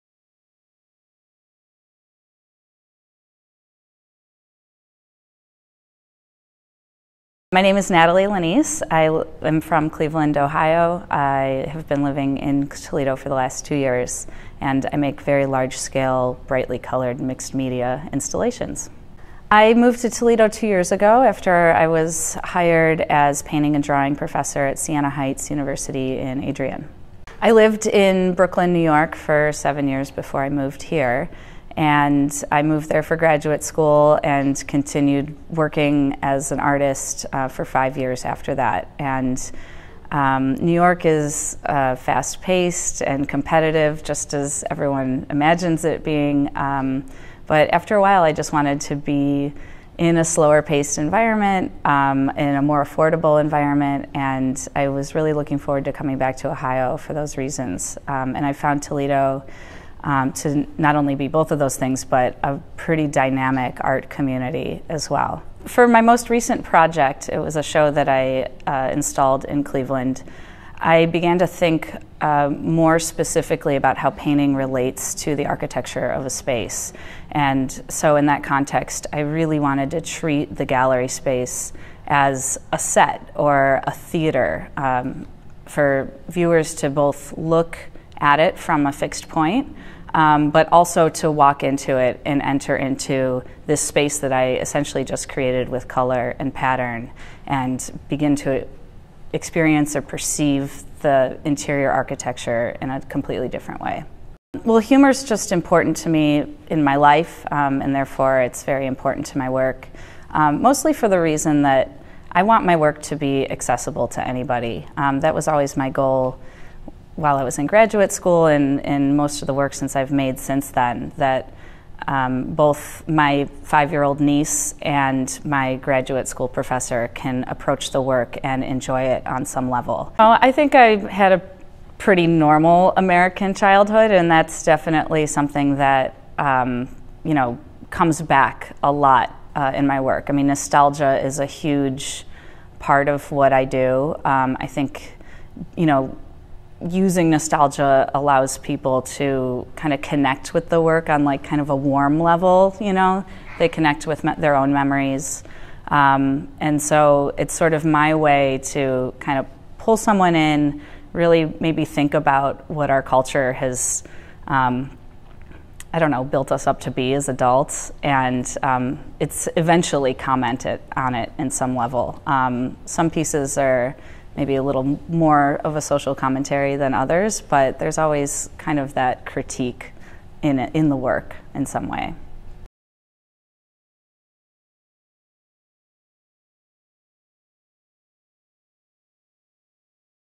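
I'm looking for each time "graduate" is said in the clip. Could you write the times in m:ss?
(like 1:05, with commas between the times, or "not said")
0:33, 1:57, 2:05.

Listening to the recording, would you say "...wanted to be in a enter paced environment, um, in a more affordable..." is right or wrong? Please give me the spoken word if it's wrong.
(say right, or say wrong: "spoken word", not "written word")
wrong: "slower", not "enter".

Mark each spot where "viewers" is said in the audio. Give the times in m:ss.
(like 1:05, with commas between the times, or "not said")
1:26.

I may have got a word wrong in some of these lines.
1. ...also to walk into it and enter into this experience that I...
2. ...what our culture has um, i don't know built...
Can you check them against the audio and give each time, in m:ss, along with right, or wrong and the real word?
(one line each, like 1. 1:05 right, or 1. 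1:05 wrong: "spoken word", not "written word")
1. 1:30 wrong: "space", not "experience"
2. 2:42 right.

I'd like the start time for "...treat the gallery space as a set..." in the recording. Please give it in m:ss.
1:20.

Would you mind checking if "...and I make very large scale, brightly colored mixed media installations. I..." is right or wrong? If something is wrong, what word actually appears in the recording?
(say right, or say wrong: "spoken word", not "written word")
right.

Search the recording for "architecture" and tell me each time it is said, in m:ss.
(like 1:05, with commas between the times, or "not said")
1:15, 1:41.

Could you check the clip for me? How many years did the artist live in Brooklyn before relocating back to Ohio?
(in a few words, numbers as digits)
7.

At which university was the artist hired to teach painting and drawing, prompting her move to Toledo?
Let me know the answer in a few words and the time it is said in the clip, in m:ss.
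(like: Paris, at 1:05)
Siena Heights University, at 0:24.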